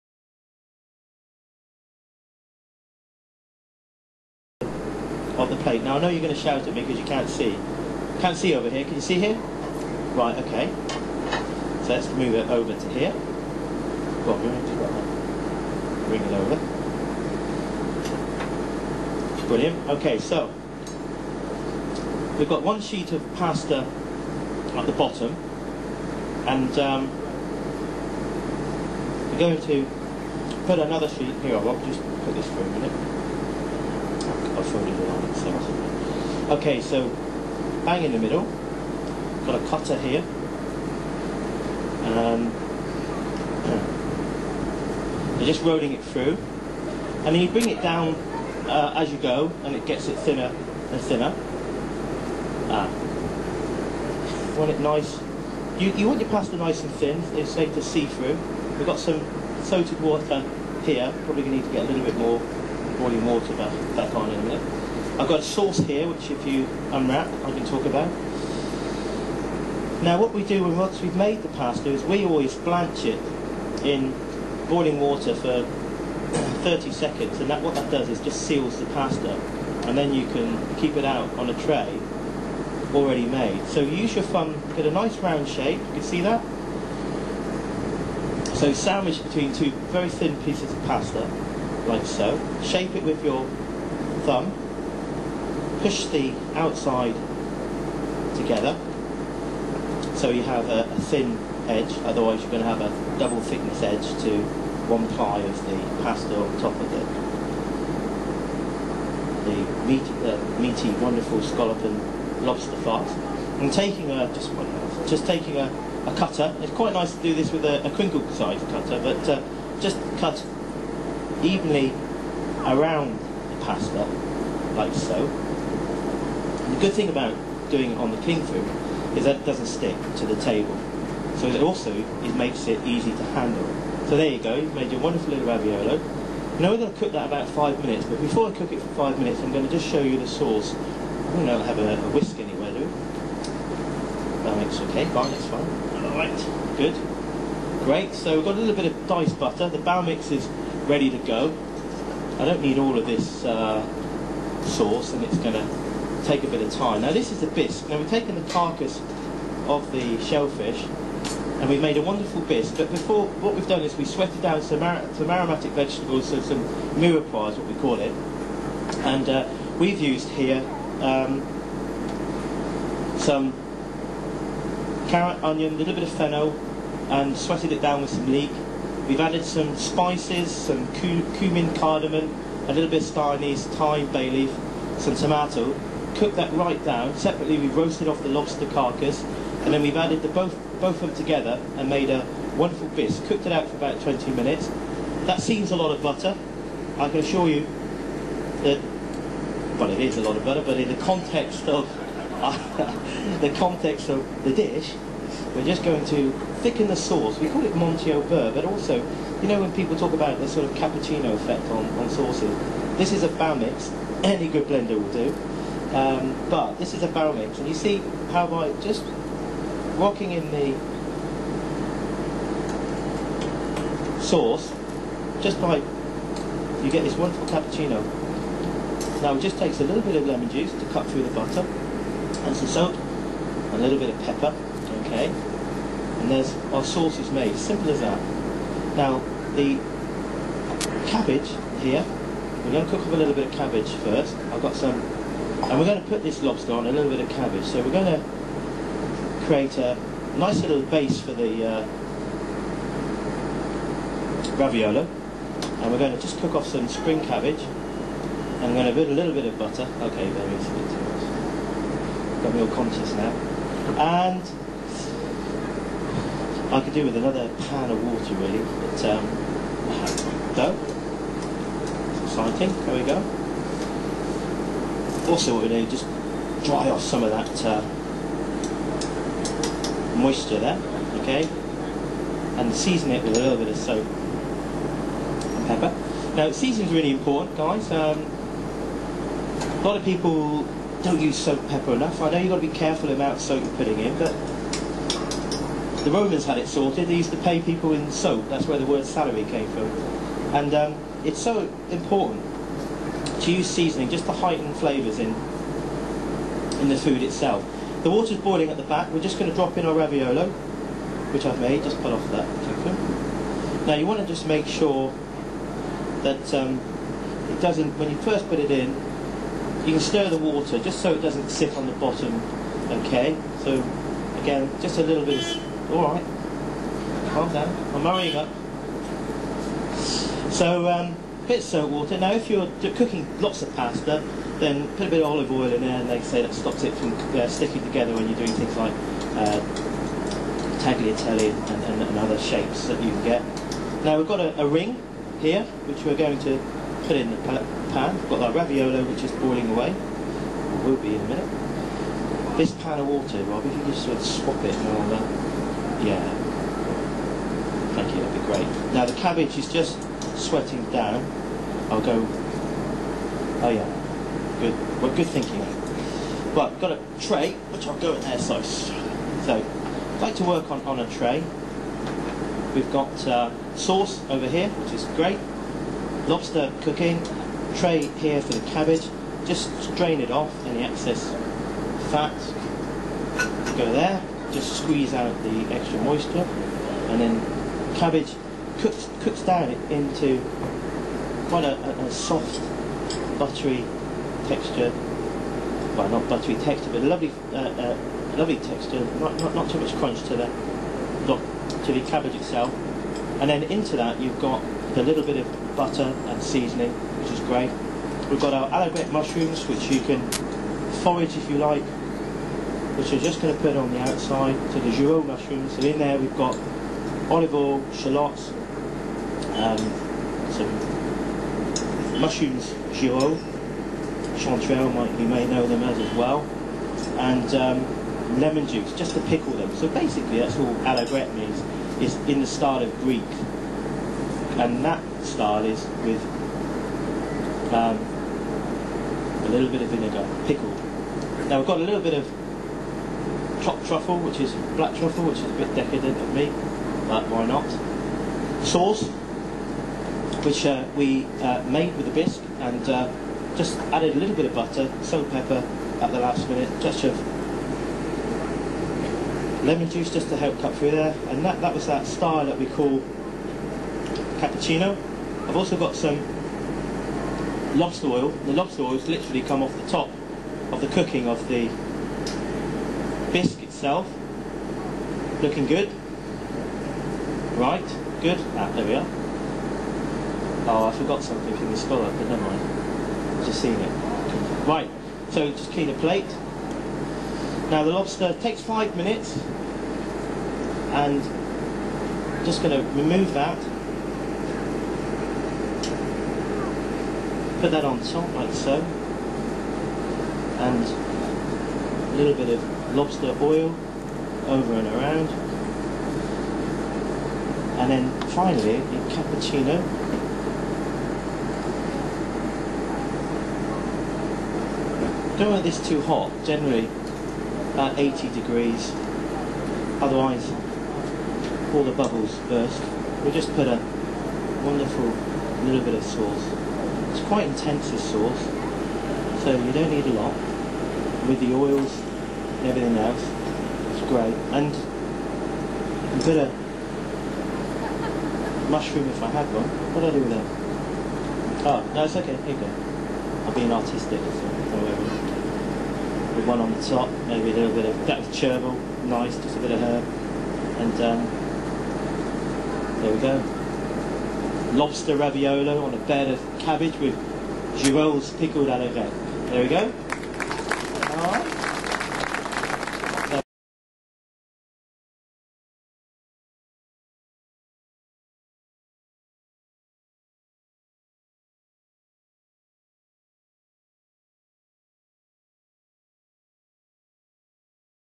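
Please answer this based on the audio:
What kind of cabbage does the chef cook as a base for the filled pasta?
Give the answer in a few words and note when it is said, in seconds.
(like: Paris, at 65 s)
spring cabbage, at 256 s.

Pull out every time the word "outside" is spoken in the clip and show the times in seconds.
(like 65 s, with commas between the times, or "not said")
96 s, 414 s.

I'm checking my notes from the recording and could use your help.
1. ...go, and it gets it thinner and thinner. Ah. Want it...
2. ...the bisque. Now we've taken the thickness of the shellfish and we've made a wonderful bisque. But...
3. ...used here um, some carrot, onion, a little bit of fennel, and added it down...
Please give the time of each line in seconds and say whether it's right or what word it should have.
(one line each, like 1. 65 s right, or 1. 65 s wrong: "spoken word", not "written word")
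1. 49 s right
2. 157 s wrong: "carcass", not "thickness"
3. 170 s wrong: "sweated", not "added".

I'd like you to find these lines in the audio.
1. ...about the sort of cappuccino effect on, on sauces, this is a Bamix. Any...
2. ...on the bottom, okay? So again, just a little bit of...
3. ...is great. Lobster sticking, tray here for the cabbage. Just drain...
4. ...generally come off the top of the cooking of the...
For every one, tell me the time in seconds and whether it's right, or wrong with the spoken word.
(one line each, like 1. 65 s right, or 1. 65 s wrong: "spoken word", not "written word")
1. 210 s right
2. 321 s right
3. 374 s wrong: "cooking", not "sticking"
4. 469 s wrong: "literally", not "generally".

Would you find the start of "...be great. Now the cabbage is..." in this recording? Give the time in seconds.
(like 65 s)
358 s.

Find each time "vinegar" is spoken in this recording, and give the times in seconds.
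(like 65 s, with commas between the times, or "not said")
439 s.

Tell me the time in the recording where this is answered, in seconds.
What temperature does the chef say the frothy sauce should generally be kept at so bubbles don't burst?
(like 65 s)
517 s.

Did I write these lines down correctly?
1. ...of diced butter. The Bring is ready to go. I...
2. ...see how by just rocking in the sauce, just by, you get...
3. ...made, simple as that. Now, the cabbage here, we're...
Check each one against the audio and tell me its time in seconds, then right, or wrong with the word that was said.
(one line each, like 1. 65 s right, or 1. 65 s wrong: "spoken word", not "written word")
1. 148 s wrong: "Bamix", not "Bring"
2. 217 s right
3. 237 s right.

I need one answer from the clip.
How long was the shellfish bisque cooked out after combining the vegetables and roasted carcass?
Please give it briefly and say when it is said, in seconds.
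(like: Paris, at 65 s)
20 minutes, at 194 s.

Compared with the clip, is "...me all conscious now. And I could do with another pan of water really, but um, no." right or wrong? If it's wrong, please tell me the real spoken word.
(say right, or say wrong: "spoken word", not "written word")
right.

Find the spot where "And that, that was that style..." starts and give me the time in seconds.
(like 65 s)
461 s.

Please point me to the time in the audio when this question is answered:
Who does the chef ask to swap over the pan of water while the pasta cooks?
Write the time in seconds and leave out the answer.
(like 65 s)
353 s.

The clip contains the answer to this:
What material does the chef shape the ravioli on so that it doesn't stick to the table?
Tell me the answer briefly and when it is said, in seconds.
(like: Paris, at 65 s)
cling film, at 128 s.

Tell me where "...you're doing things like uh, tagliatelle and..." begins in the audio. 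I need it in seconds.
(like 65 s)
338 s.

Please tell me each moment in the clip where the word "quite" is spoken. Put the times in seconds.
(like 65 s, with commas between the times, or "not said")
116 s, 391 s, 527 s.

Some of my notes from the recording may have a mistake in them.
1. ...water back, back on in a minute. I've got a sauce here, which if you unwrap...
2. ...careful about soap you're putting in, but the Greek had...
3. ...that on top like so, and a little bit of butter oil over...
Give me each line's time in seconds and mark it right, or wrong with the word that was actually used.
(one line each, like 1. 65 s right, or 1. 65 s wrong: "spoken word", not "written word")
1. 63 s right
2. 292 s wrong: "Romans", not "Greek"
3. 497 s wrong: "lobster", not "butter".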